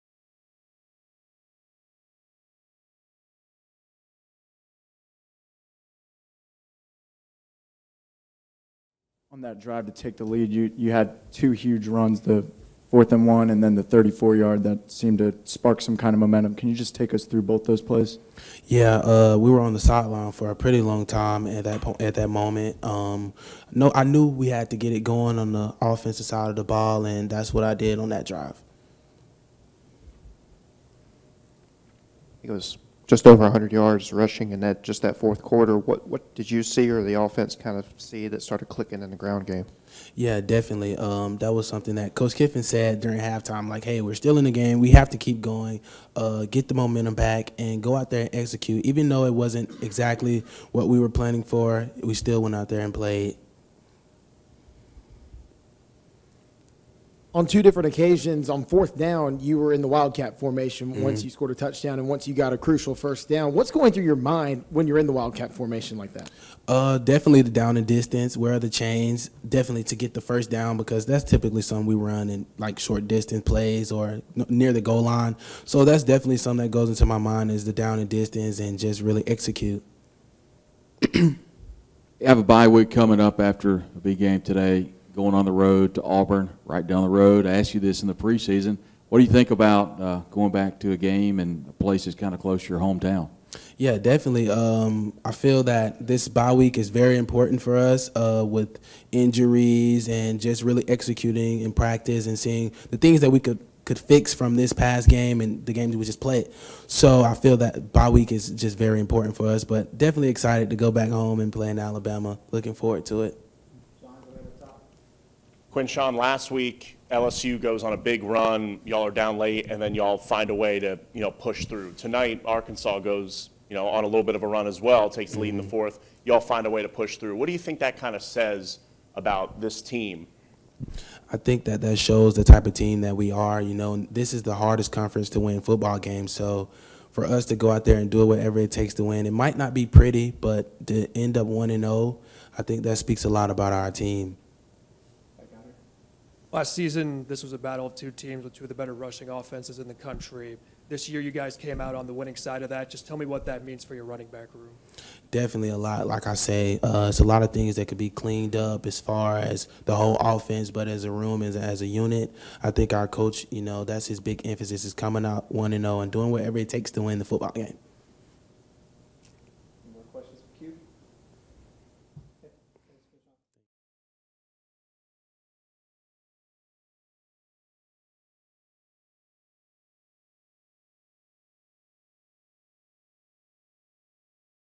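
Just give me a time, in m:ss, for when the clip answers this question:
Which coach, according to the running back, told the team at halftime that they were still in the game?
0:42.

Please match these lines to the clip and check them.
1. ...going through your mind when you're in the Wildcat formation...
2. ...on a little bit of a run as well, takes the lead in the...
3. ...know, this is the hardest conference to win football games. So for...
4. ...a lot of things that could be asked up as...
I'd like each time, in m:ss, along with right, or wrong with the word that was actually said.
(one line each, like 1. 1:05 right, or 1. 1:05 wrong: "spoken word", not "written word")
1. 1:03 right
2. 2:03 right
3. 2:13 right
4. 2:37 wrong: "cleaned", not "asked".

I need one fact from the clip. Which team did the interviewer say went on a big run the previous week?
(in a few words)
LSU.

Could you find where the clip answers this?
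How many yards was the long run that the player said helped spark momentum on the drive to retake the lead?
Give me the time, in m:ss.
0:13.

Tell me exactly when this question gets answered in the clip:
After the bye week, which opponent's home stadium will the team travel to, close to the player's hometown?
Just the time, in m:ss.
1:26.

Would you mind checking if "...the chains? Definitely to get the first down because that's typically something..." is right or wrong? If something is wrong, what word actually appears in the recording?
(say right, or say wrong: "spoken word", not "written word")
right.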